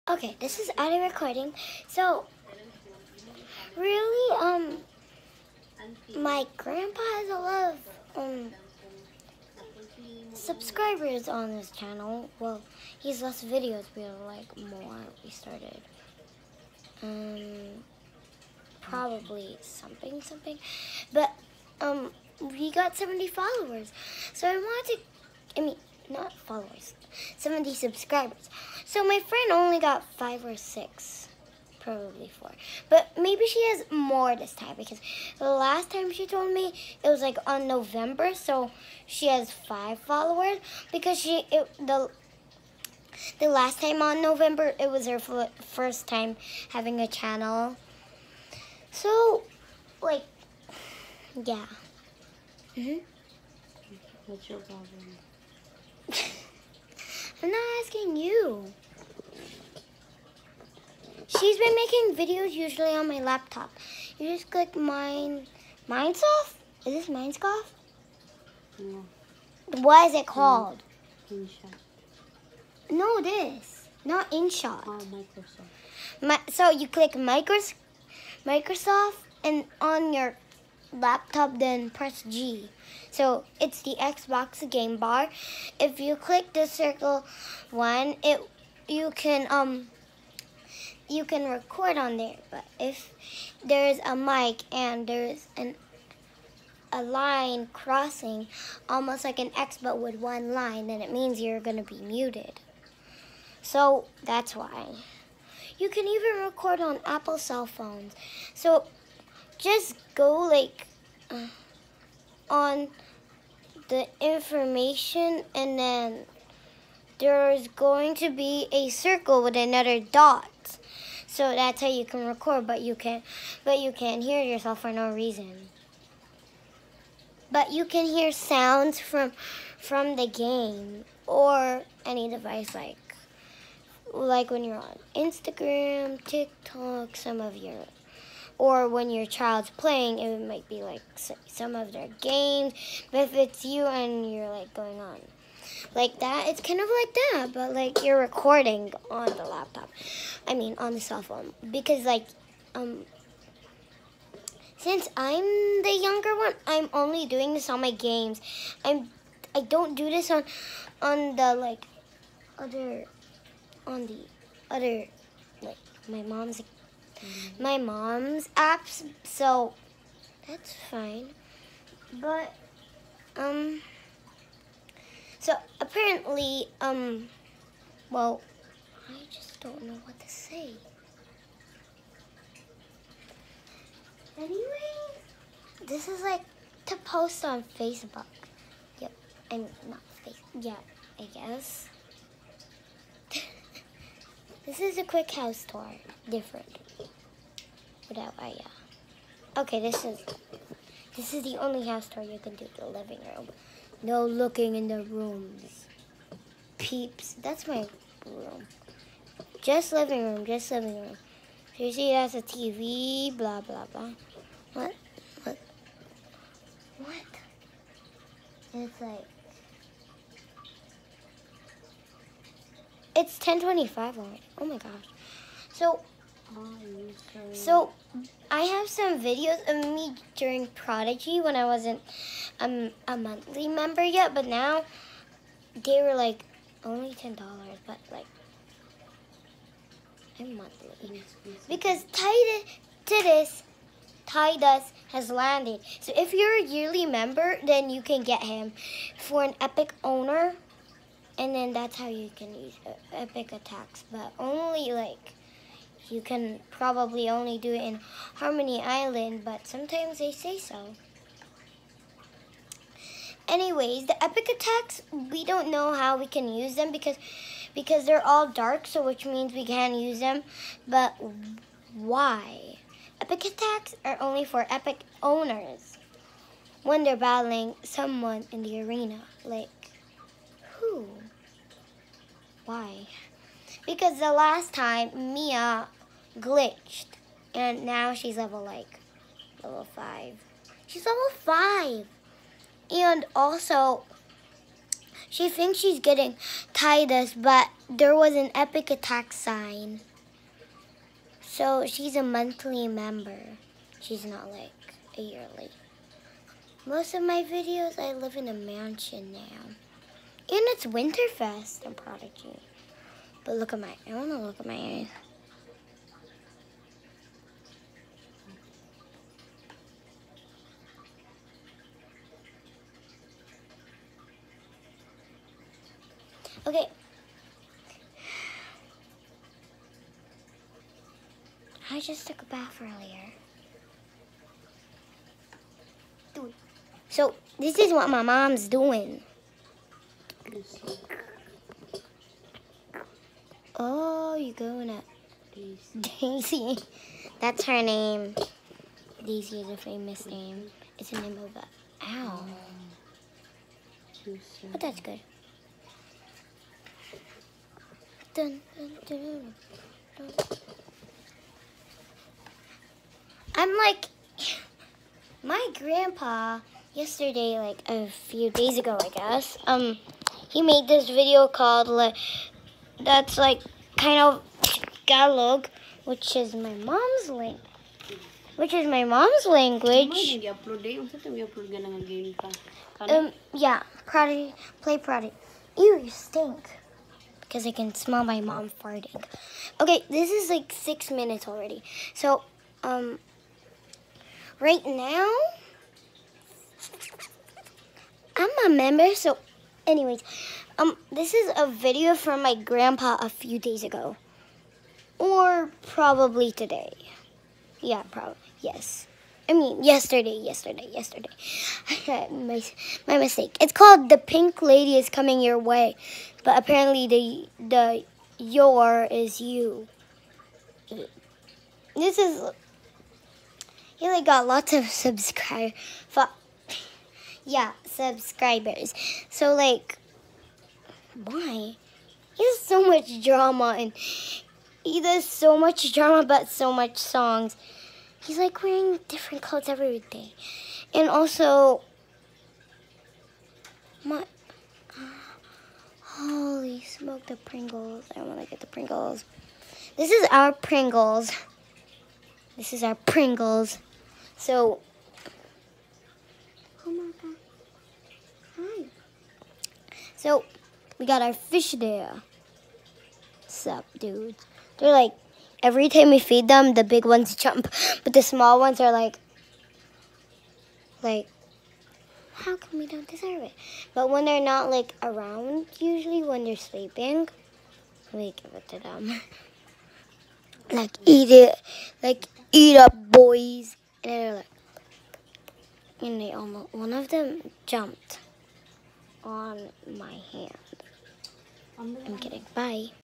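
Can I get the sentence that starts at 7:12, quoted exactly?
He has so much drama and he does so much drama but so much songs.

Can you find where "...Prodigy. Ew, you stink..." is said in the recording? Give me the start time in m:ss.
6:24.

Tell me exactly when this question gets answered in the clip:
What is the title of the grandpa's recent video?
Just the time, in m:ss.
6:54.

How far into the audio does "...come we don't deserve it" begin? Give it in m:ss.
7:52.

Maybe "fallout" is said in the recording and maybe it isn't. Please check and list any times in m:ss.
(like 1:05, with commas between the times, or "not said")
not said.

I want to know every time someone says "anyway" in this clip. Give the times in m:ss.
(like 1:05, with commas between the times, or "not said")
3:04, 4:23, 6:39.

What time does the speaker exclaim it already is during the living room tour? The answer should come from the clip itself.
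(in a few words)
10:25.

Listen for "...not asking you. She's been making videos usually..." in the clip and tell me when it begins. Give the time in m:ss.
0:57.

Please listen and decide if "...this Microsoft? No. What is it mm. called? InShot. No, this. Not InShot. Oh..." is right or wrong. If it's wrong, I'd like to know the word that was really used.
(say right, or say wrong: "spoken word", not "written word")
wrong: "Minesoft", not "Microsoft".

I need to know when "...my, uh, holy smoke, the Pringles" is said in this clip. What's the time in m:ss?
7:24.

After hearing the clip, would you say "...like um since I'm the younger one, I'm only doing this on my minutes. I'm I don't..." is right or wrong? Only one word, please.
wrong.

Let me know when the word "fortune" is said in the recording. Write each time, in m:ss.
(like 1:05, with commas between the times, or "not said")
not said.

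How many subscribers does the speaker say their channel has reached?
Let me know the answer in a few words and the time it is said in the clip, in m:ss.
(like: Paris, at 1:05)
70, at 0:27.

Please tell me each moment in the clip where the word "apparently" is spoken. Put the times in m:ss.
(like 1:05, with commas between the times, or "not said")
2:55, 6:56.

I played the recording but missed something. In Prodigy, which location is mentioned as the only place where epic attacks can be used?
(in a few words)
Harmony Island.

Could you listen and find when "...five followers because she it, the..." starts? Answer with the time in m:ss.
0:39.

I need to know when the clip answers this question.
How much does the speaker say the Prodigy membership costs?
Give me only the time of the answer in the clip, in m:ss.
3:57.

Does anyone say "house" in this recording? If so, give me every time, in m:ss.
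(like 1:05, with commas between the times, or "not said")
3:15, 3:21.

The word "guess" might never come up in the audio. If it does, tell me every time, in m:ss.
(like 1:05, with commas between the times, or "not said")
3:11, 6:09.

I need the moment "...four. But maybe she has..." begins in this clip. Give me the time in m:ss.
0:32.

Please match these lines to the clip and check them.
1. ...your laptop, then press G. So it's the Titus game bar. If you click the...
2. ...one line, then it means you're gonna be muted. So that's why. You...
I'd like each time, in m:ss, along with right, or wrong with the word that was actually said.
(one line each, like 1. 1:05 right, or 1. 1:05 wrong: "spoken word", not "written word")
1. 1:20 wrong: "Xbox", not "Titus"
2. 1:40 right.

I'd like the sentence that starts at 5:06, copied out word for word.
Most of my videos, I live in a mansion now.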